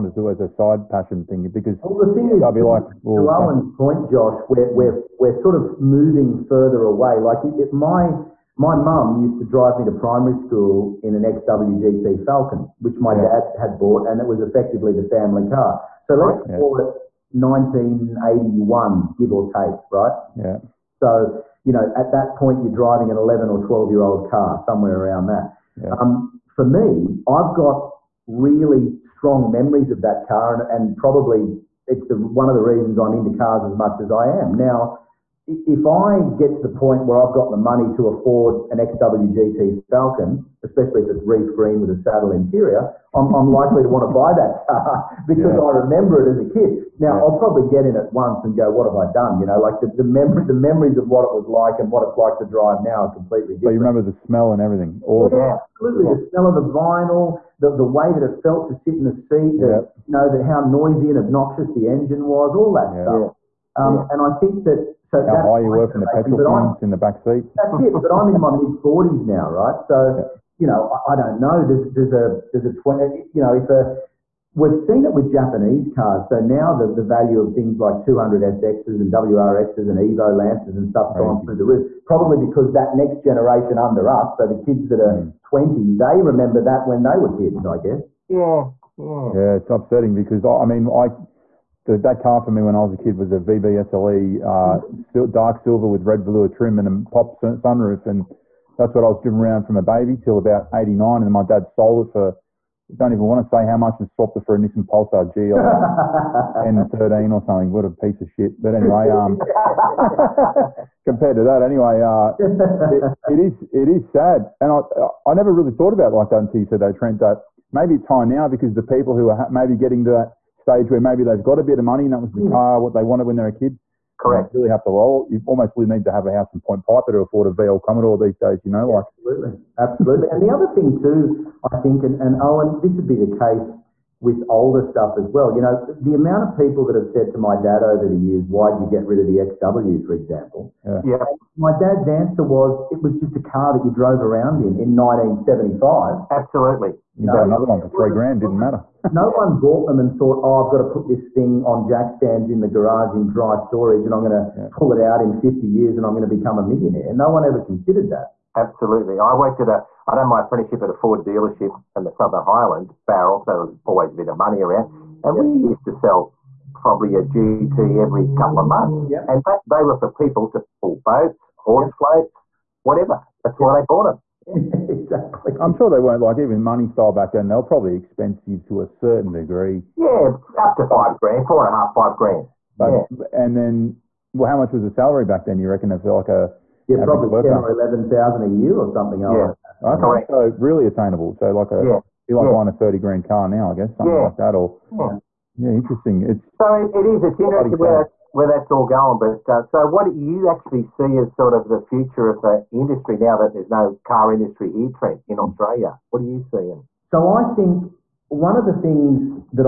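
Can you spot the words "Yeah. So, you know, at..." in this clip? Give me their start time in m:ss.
0:20.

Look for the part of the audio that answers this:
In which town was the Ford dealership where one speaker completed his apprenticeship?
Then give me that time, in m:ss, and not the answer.
2:43.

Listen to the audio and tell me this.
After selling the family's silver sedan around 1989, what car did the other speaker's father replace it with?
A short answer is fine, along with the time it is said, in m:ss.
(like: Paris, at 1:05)
Nissan Pulsar GLS, at 1:44.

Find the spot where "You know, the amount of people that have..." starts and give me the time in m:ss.
2:15.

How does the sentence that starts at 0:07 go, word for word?
Like it, my my mum used to drive me to primary school in an XWGT Falcon, which my yeah.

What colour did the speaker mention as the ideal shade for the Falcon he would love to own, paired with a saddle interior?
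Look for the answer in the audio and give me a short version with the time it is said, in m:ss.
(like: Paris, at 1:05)
Reef green, at 0:41.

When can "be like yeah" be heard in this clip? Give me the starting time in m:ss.
3:12.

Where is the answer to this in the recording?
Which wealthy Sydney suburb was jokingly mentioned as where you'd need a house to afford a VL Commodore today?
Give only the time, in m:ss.
2:06.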